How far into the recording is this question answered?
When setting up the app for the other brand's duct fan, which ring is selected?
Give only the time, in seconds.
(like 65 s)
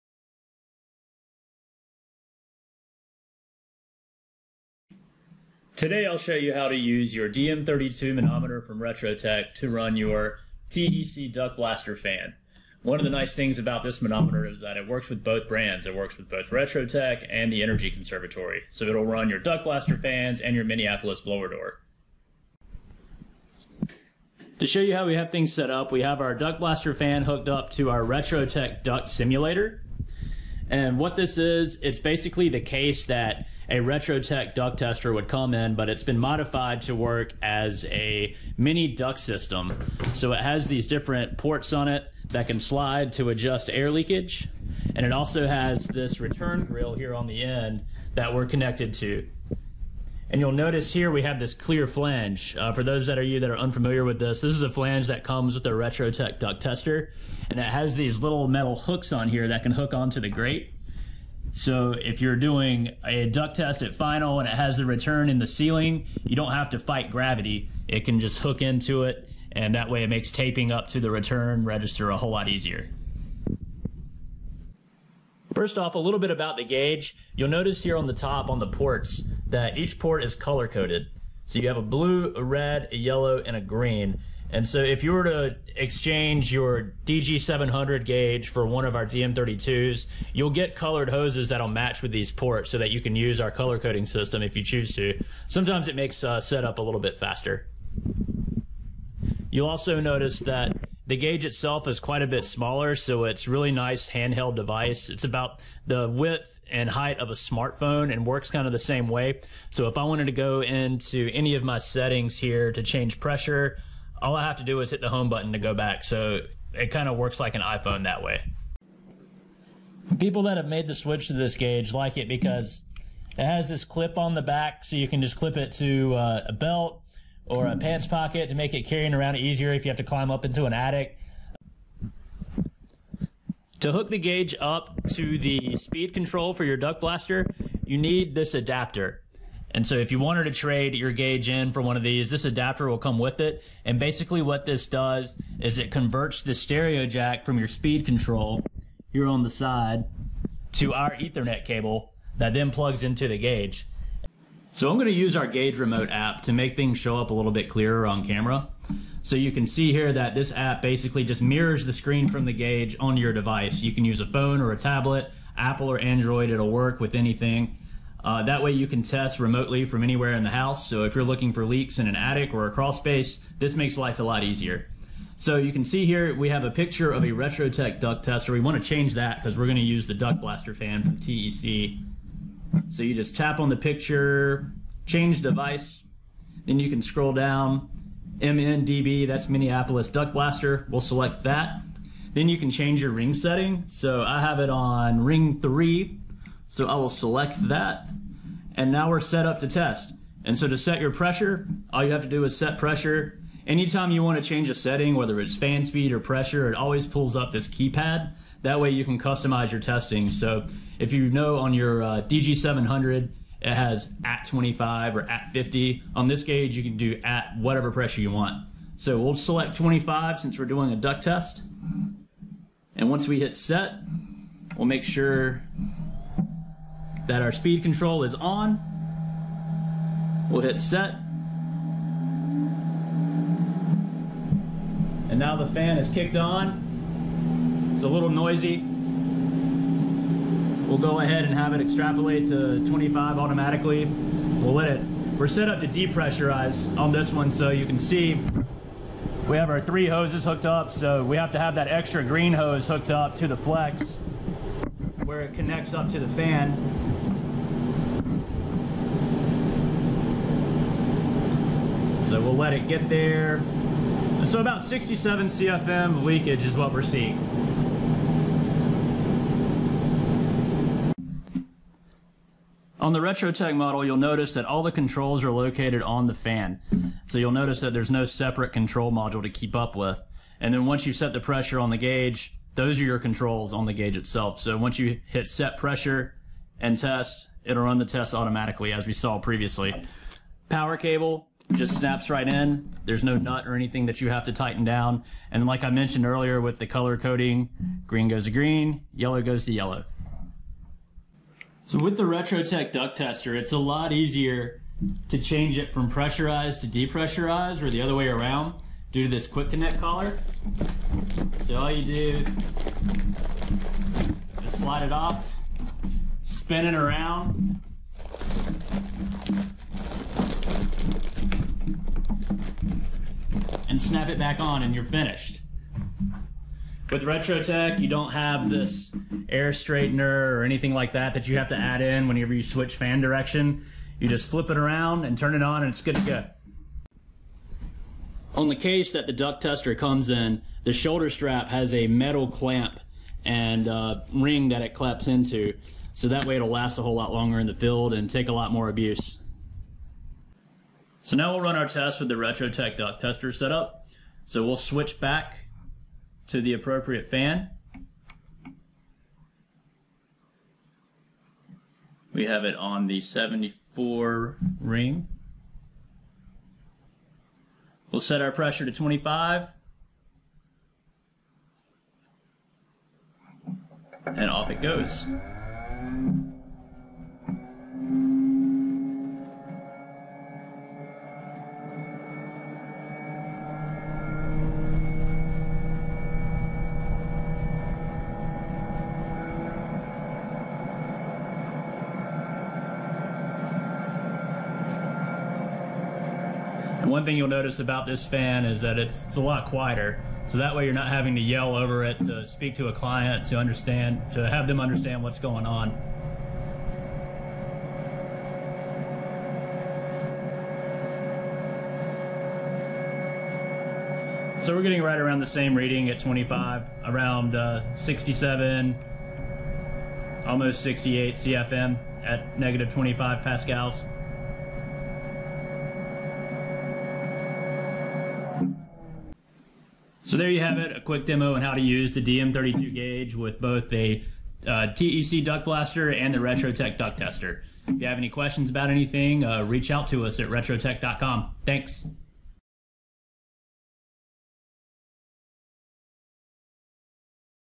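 195 s.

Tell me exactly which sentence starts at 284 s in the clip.
So once you hit set pressure and test, it'll run the test automatically as we saw previously.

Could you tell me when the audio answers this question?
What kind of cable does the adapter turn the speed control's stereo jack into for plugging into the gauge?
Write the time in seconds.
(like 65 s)
151 s.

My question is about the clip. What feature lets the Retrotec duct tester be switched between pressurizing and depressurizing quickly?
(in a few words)
quick connect collar.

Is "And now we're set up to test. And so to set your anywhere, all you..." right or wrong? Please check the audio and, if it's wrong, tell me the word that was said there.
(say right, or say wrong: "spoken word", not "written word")
wrong: "pressure", not "anywhere".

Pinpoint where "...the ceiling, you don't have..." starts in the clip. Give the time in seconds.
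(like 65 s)
65 s.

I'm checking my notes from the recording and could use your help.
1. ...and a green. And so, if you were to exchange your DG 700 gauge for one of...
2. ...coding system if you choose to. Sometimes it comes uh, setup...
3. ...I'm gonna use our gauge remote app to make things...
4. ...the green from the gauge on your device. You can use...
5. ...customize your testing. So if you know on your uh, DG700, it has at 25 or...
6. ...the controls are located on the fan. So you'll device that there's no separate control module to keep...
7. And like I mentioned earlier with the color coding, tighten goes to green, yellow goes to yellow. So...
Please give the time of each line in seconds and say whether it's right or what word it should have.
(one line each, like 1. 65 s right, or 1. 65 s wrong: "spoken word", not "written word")
1. 83 s right
2. 93 s wrong: "makes", not "comes"
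3. 154 s right
4. 161 s wrong: "screen", not "green"
5. 209 s right
6. 274 s wrong: "notice", not "device"
7. 295 s wrong: "green", not "tighten".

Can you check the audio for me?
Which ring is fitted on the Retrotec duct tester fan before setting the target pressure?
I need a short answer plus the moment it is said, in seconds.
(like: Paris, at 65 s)
74 ring, at 363 s.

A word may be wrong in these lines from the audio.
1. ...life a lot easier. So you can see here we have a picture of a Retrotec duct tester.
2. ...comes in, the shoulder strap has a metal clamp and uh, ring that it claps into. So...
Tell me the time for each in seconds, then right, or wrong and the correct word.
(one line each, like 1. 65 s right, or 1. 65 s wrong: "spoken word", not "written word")
1. 173 s right
2. 339 s right.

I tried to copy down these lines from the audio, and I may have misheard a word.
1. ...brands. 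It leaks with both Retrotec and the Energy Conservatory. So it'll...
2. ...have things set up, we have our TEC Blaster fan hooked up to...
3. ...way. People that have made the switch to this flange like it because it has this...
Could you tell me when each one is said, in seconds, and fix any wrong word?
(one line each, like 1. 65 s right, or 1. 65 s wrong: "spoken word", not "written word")
1. 15 s wrong: "works", not "leaks"
2. 25 s wrong: "Duct", not "TEC"
3. 118 s wrong: "gauge", not "flange".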